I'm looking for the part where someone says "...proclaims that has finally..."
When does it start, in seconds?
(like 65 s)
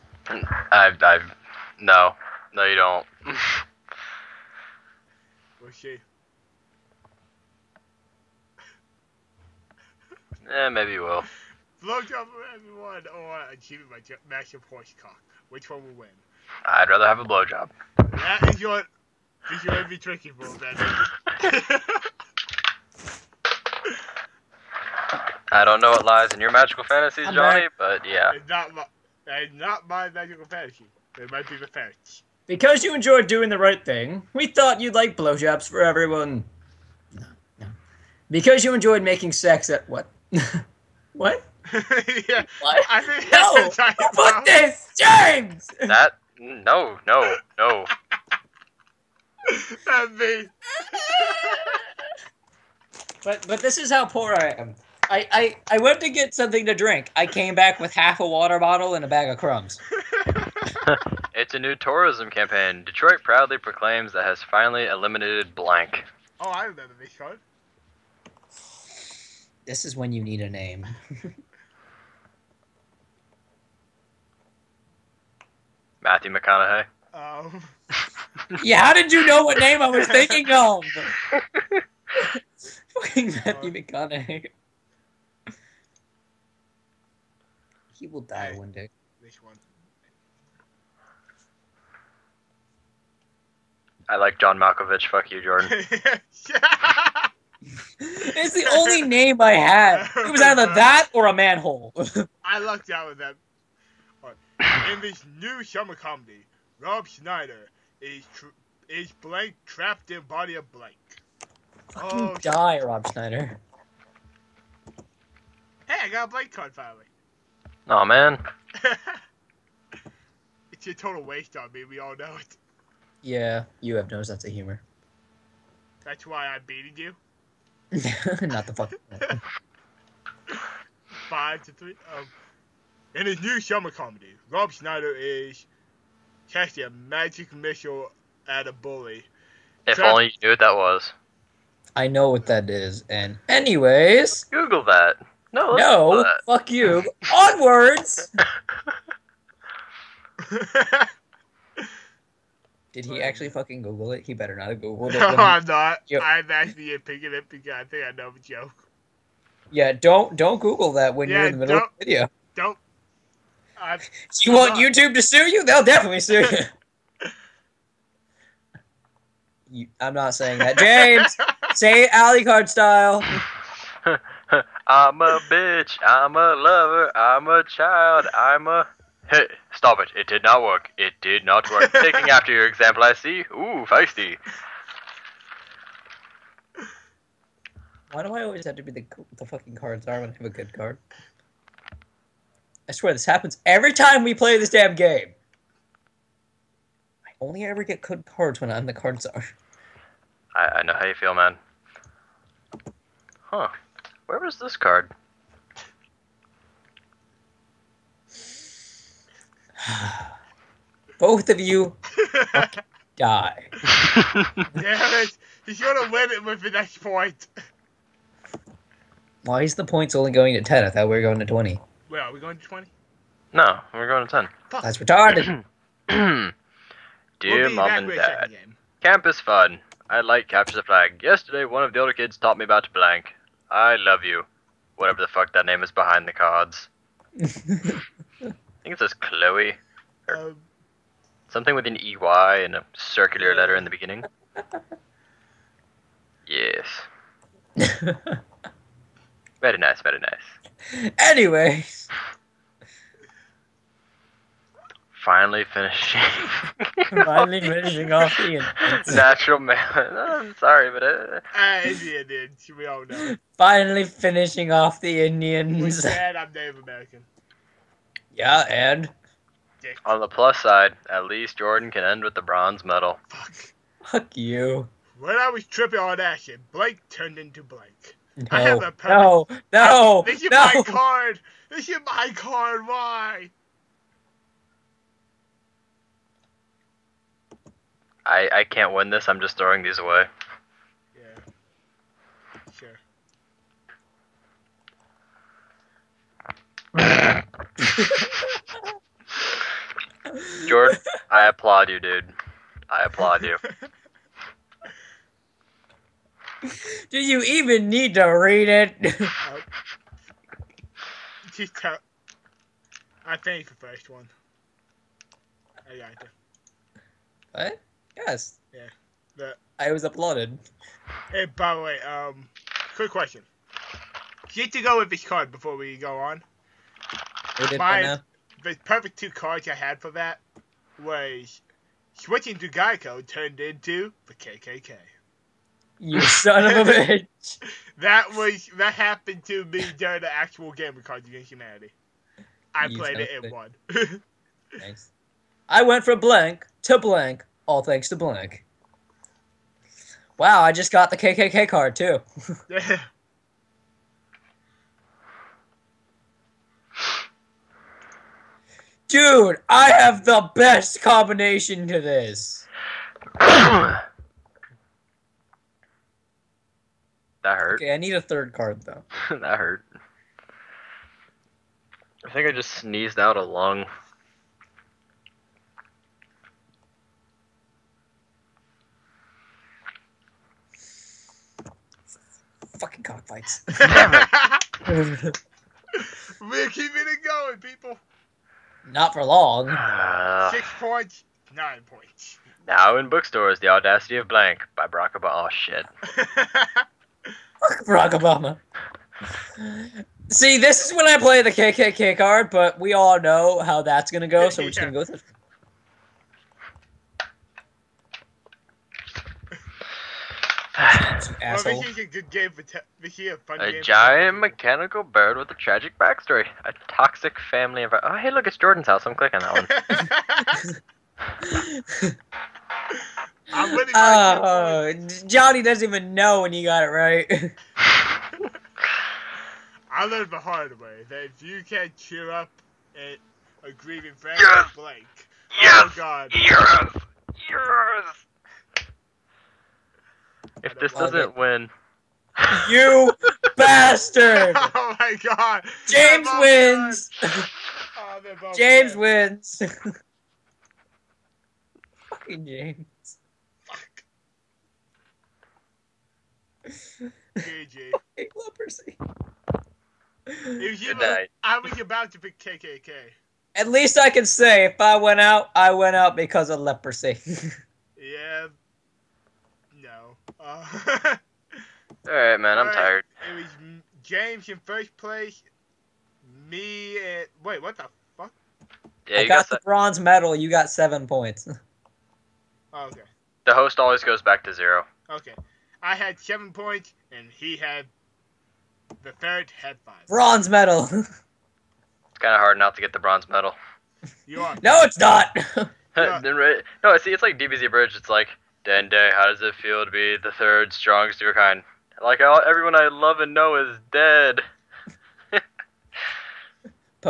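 63 s.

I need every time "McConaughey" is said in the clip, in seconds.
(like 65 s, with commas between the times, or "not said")
76 s, 83 s.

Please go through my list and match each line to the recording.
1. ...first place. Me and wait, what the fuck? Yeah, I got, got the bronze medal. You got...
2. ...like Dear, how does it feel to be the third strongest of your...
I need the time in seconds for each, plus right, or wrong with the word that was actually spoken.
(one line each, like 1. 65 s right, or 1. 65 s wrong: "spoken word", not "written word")
1. 474 s right
2. 498 s wrong: "Dende", not "Dear".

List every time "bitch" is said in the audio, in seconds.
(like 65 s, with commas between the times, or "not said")
175 s, 336 s.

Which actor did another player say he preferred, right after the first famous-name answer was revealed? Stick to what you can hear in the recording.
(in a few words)
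John Malkovich.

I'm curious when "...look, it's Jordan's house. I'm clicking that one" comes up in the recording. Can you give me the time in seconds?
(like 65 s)
418 s.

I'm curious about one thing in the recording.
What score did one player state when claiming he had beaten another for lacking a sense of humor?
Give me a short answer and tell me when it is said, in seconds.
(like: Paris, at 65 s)
5 to 3, at 131 s.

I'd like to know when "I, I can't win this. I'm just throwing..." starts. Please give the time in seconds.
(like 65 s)
288 s.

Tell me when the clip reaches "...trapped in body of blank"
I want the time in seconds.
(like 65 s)
109 s.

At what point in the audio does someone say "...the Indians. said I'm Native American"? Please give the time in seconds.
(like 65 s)
264 s.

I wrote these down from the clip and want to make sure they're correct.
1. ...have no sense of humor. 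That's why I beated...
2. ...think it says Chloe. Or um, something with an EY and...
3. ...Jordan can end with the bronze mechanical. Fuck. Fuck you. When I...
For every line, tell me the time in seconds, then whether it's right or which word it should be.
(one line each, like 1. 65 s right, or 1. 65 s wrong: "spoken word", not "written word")
1. 123 s right
2. 237 s right
3. 271 s wrong: "medal", not "mechanical".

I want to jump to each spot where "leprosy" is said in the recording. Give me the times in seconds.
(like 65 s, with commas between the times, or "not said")
458 s, 466 s.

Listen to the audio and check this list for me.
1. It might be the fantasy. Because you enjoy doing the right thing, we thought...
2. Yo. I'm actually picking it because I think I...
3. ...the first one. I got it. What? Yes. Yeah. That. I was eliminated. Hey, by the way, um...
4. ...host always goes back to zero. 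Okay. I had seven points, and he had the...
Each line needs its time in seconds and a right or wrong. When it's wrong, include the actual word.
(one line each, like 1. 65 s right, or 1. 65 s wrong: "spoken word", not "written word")
1. 31 s right
2. 156 s right
3. 313 s wrong: "applauded", not "eliminated"
4. 483 s right.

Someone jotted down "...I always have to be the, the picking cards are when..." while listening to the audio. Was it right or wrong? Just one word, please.
wrong.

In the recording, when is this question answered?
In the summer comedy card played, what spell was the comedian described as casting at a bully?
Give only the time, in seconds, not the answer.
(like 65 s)
136 s.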